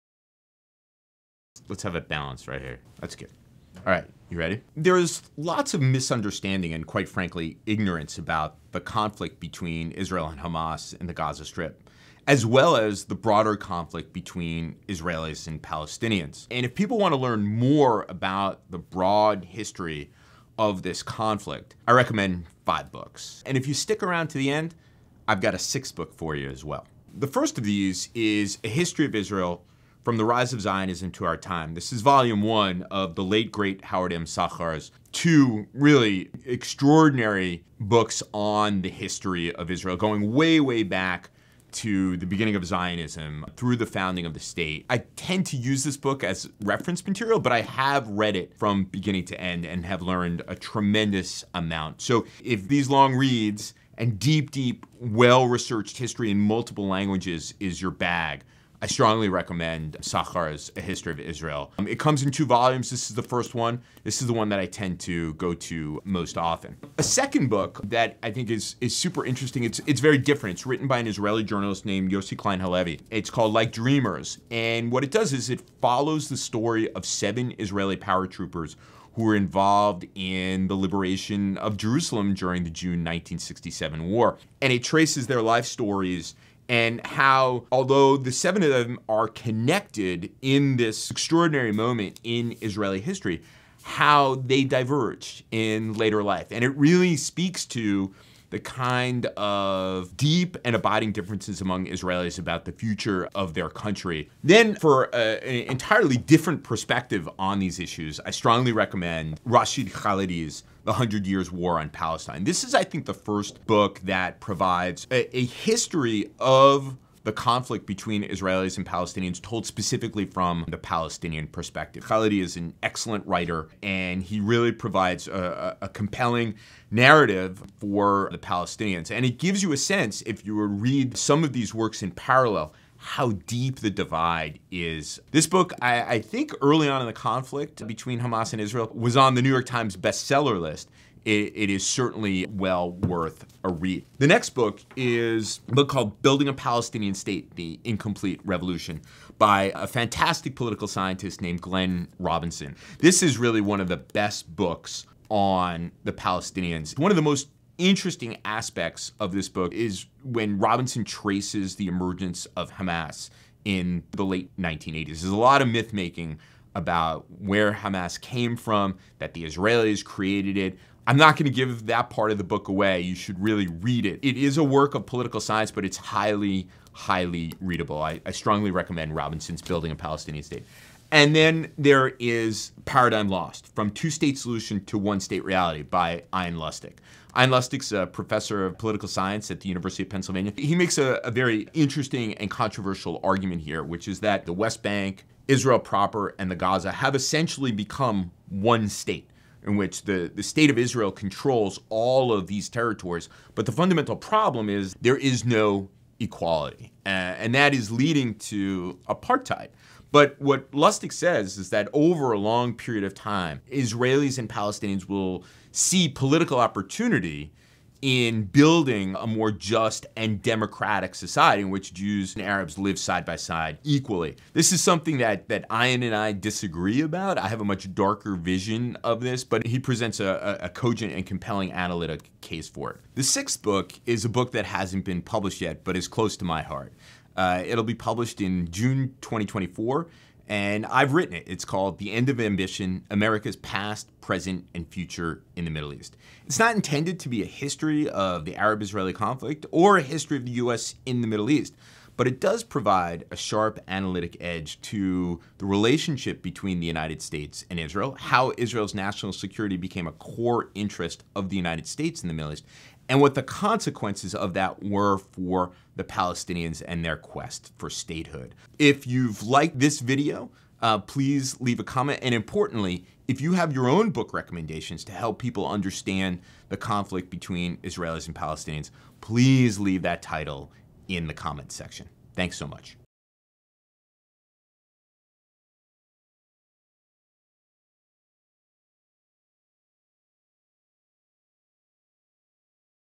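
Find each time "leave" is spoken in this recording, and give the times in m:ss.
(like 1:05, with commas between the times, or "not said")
4:31, 4:39.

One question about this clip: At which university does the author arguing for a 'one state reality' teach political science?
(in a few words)
University of Pennsylvania.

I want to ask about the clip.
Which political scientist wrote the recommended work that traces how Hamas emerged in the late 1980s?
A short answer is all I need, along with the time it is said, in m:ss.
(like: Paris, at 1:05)
Glenn Robinson, at 2:31.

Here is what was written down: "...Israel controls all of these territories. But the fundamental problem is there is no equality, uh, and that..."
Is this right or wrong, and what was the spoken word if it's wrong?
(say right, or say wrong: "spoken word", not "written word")
right.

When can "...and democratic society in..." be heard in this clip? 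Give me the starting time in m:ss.
3:40.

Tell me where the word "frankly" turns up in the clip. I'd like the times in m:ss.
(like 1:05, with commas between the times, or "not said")
0:07.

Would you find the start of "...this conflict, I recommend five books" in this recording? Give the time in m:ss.
0:20.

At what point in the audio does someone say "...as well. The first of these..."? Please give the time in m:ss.
0:26.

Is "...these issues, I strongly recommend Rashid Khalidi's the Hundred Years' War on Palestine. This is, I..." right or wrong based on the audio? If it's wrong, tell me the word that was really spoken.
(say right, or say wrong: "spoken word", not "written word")
right.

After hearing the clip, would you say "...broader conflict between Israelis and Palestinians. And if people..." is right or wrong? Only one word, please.
right.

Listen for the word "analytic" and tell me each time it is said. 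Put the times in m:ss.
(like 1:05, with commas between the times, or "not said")
3:51, 4:13.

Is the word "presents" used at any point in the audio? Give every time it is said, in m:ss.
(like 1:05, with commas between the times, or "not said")
3:49, 4:04.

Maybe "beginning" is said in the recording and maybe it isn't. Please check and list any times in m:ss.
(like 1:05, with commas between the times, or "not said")
0:42, 0:48.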